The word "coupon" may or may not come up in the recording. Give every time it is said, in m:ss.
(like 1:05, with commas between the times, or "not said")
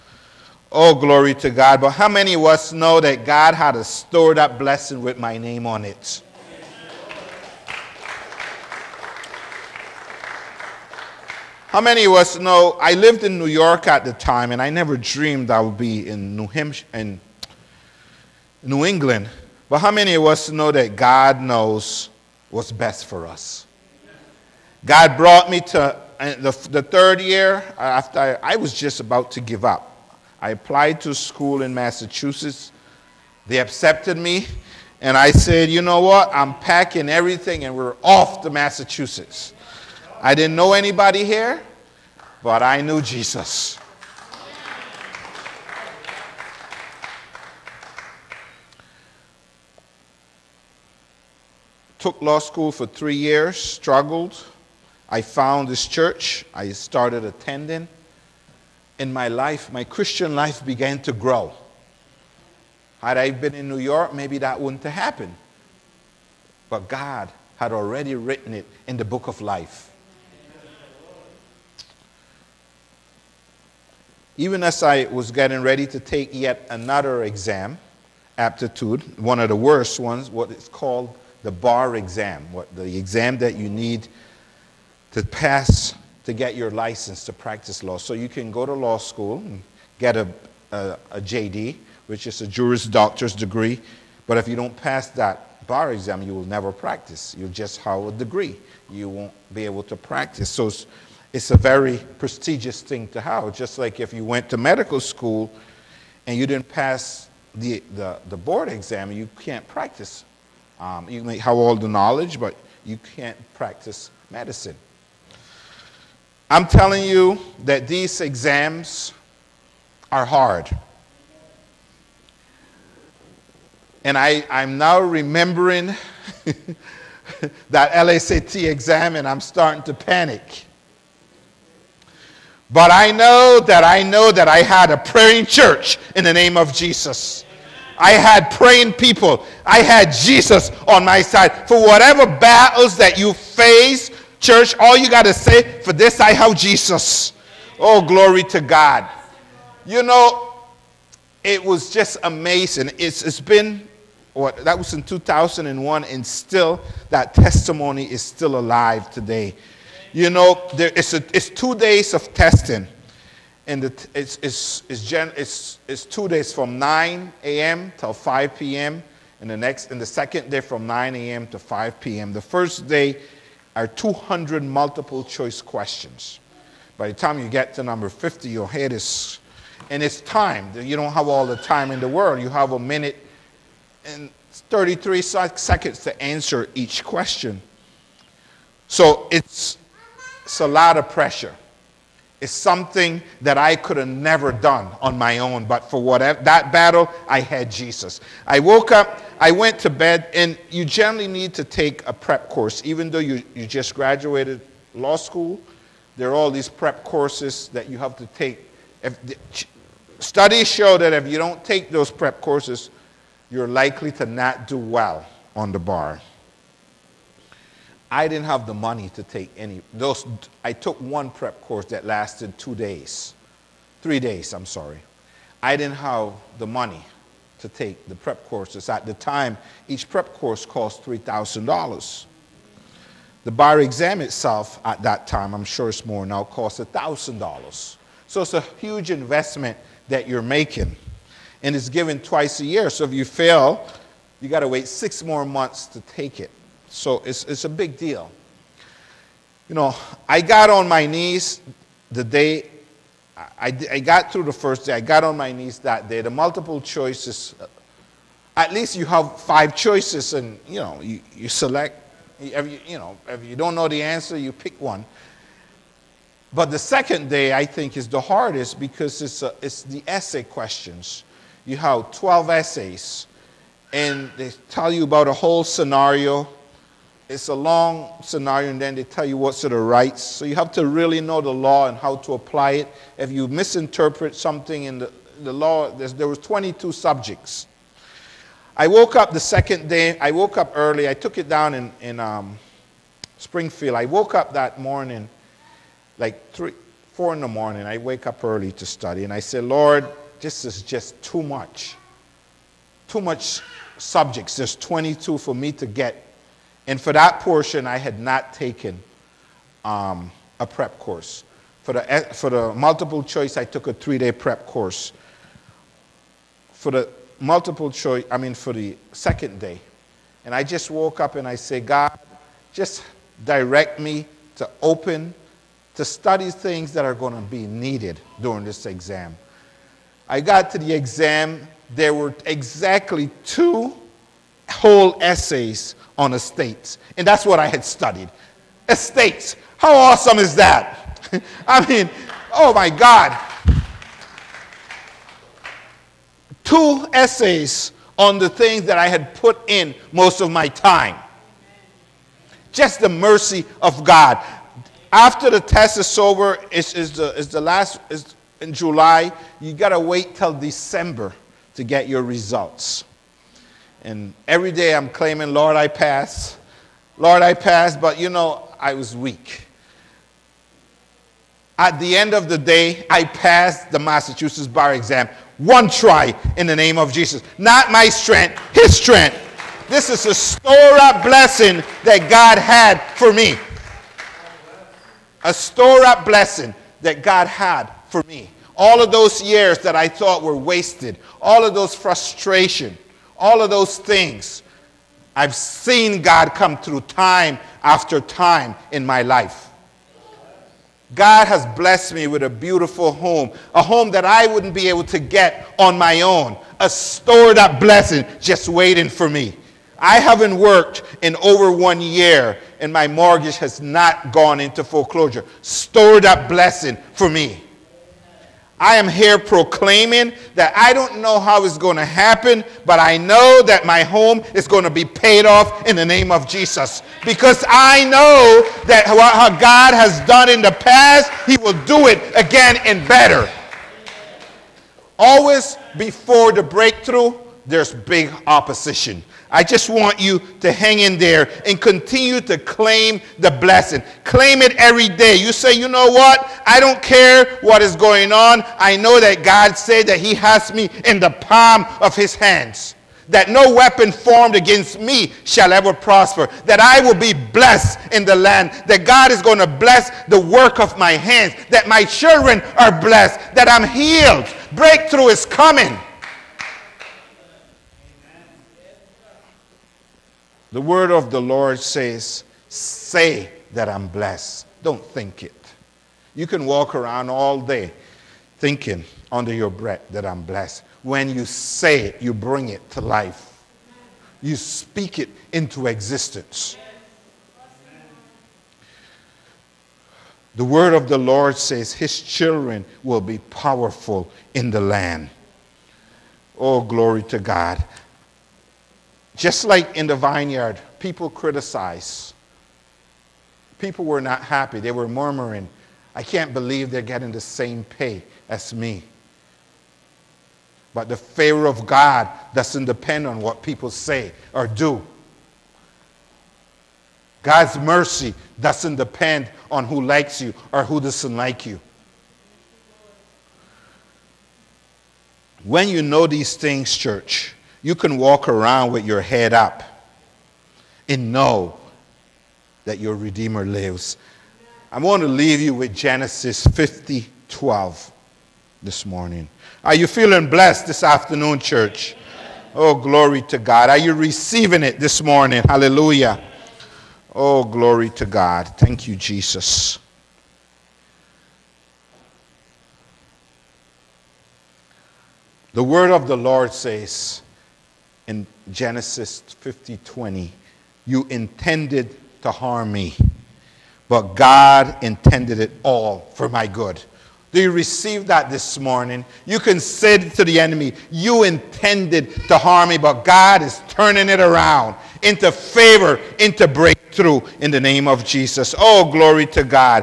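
not said.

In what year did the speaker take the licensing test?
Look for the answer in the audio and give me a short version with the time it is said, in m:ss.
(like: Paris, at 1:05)
2001, at 2:35.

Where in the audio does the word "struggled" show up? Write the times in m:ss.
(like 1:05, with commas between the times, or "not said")
0:53.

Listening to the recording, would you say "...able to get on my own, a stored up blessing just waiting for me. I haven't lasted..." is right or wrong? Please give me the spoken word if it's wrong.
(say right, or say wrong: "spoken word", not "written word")
wrong: "worked", not "lasted".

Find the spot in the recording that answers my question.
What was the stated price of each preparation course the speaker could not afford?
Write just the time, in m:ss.
3:51.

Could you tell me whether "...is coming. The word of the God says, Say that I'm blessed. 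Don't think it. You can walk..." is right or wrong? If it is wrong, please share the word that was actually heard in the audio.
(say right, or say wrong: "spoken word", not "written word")
wrong: "Lord", not "God".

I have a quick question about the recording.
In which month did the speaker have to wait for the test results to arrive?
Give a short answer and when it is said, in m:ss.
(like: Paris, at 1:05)
December, at 6:00.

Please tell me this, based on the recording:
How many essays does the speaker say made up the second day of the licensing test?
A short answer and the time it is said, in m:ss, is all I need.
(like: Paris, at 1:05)
12, at 4:32.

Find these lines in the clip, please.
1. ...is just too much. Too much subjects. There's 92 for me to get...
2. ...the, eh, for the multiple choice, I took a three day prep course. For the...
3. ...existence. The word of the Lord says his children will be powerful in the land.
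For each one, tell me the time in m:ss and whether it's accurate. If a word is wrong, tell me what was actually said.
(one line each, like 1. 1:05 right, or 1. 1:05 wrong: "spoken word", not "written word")
1. 5:00 wrong: "22", not "92"
2. 5:11 right
3. 8:05 right.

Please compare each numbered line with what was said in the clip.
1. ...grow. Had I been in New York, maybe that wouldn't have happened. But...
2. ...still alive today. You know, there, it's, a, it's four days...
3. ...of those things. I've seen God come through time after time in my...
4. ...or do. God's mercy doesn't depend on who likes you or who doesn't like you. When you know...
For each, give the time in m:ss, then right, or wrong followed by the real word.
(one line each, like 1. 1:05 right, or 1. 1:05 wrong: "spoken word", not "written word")
1. 1:01 right
2. 2:38 wrong: "two", not "four"
3. 6:33 right
4. 8:34 right.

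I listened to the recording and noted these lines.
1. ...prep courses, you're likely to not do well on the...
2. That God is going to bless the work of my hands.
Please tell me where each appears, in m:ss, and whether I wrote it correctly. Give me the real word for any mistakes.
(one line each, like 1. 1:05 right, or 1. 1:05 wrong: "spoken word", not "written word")
1. 3:32 right
2. 7:38 right.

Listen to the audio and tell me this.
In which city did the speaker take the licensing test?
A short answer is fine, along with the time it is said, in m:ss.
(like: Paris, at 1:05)
Springfield, at 4:53.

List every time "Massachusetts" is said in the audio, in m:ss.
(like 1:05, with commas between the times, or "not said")
0:31, 0:38, 6:13.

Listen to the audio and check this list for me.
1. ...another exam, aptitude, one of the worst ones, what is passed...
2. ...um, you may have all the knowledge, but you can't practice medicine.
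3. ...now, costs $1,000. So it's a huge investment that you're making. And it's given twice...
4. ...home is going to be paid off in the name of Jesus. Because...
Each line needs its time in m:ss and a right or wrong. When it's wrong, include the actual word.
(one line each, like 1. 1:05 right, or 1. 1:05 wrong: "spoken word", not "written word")
1. 1:16 wrong: "called", not "passed"
2. 1:50 right
3. 3:56 right
4. 7:04 right.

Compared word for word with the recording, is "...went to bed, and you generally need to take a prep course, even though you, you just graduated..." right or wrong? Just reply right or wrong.
right.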